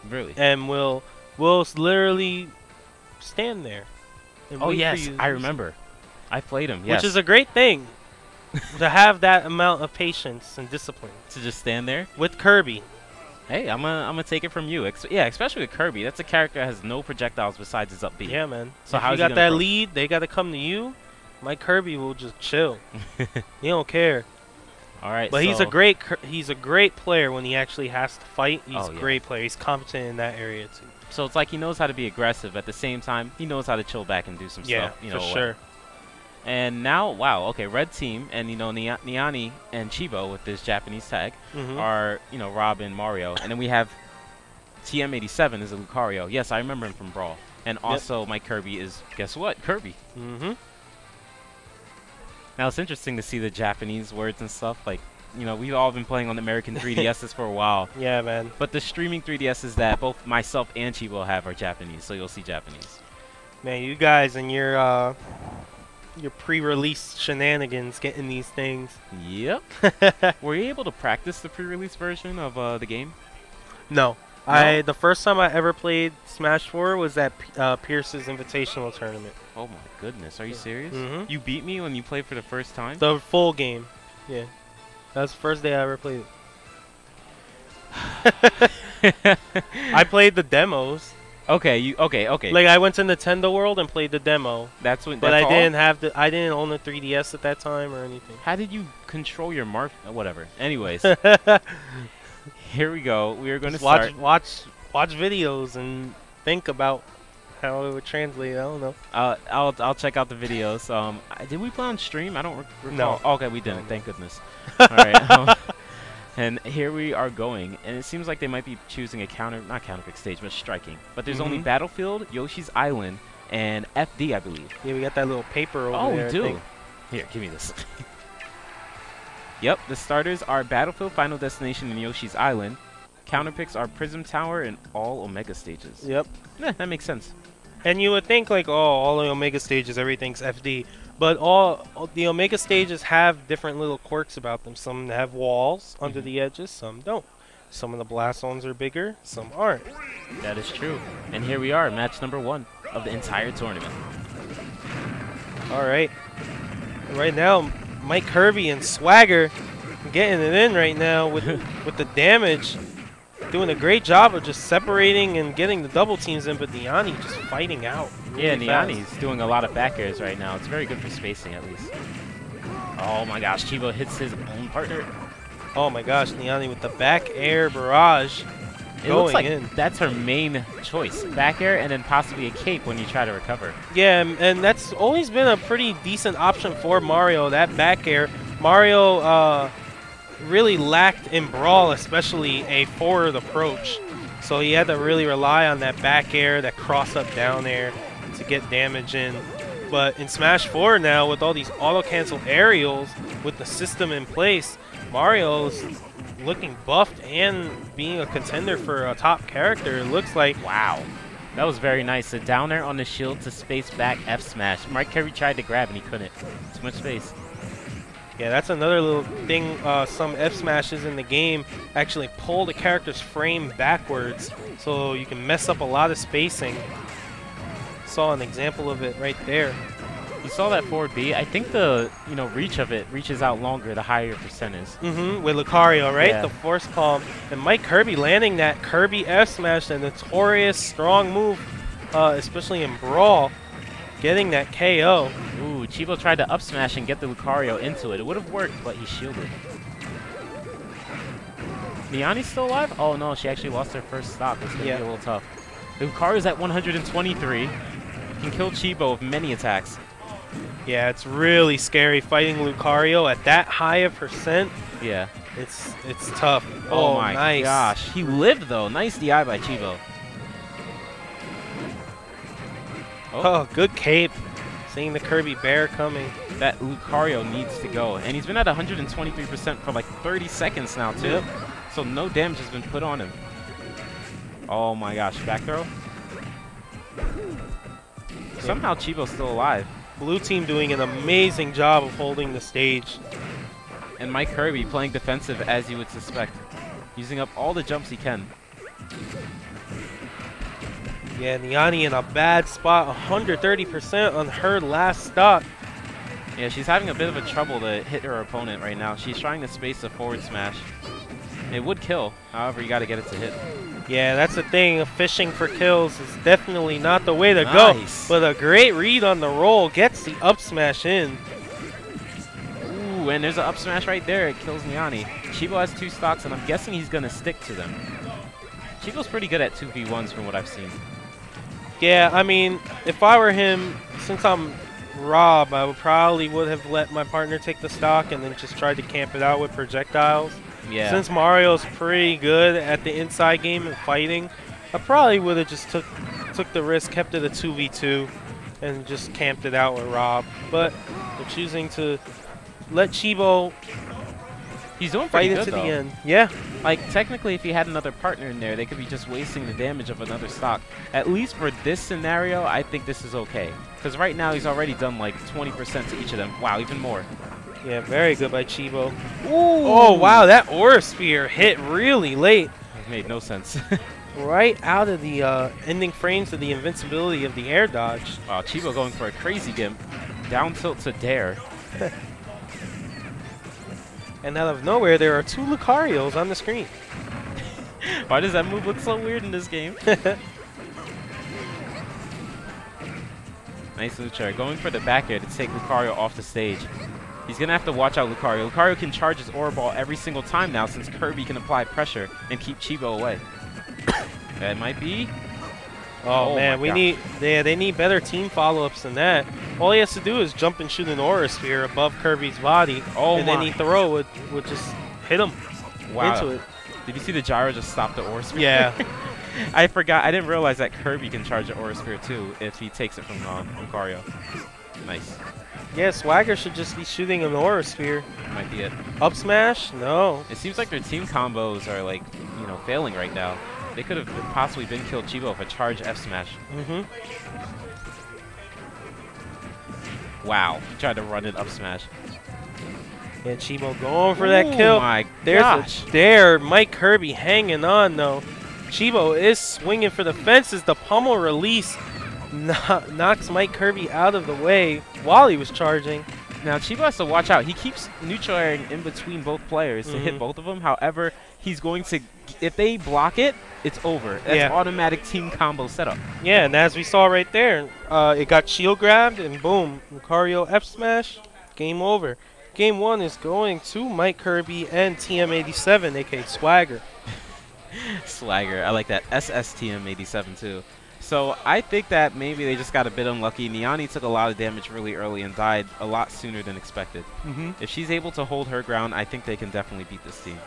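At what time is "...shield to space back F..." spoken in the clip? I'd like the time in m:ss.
3:33.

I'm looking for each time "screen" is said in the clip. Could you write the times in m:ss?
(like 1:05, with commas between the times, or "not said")
6:26.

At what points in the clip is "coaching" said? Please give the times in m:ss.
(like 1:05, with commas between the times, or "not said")
not said.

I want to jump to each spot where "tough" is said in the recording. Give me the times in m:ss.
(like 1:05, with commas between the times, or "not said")
4:15, 4:26.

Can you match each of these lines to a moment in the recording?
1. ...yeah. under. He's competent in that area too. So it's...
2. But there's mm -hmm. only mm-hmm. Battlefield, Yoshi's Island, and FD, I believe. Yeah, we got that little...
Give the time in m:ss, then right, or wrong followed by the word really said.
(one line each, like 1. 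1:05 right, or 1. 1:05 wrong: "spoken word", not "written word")
1. 0:29 wrong: "player", not "under"
2. 2:01 right.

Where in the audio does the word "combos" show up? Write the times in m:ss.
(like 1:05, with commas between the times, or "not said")
7:11, 7:45.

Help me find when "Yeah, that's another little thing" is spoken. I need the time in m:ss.
3:38.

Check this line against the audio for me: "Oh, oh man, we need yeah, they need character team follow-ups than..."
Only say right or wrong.
wrong.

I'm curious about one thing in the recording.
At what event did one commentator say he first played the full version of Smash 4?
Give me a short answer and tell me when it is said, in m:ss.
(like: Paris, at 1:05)
Pierce's Invitational, at 1:17.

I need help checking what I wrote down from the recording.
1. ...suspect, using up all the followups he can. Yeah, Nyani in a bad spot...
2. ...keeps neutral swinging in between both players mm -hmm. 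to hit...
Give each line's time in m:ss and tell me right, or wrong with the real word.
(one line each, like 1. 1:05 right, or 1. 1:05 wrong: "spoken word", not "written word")
1. 4:56 wrong: "jumps", not "followups"
2. 7:37 wrong: "airing", not "swinging".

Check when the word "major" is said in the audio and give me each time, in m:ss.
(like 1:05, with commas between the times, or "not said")
not said.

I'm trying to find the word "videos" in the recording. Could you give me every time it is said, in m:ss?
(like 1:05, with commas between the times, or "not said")
1:45, 1:50.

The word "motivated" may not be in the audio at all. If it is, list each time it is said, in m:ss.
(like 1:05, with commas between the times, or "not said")
not said.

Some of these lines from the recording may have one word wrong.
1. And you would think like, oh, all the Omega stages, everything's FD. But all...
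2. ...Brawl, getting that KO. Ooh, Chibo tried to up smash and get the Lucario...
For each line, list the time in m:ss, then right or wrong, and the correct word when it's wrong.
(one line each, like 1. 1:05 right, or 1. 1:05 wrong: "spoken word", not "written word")
1. 2:17 right
2. 4:02 right.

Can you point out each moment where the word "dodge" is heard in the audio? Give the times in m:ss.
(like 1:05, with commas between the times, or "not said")
6:17.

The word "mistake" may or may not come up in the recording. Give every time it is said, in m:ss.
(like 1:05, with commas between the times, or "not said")
not said.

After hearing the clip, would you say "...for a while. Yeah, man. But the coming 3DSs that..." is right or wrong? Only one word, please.
wrong.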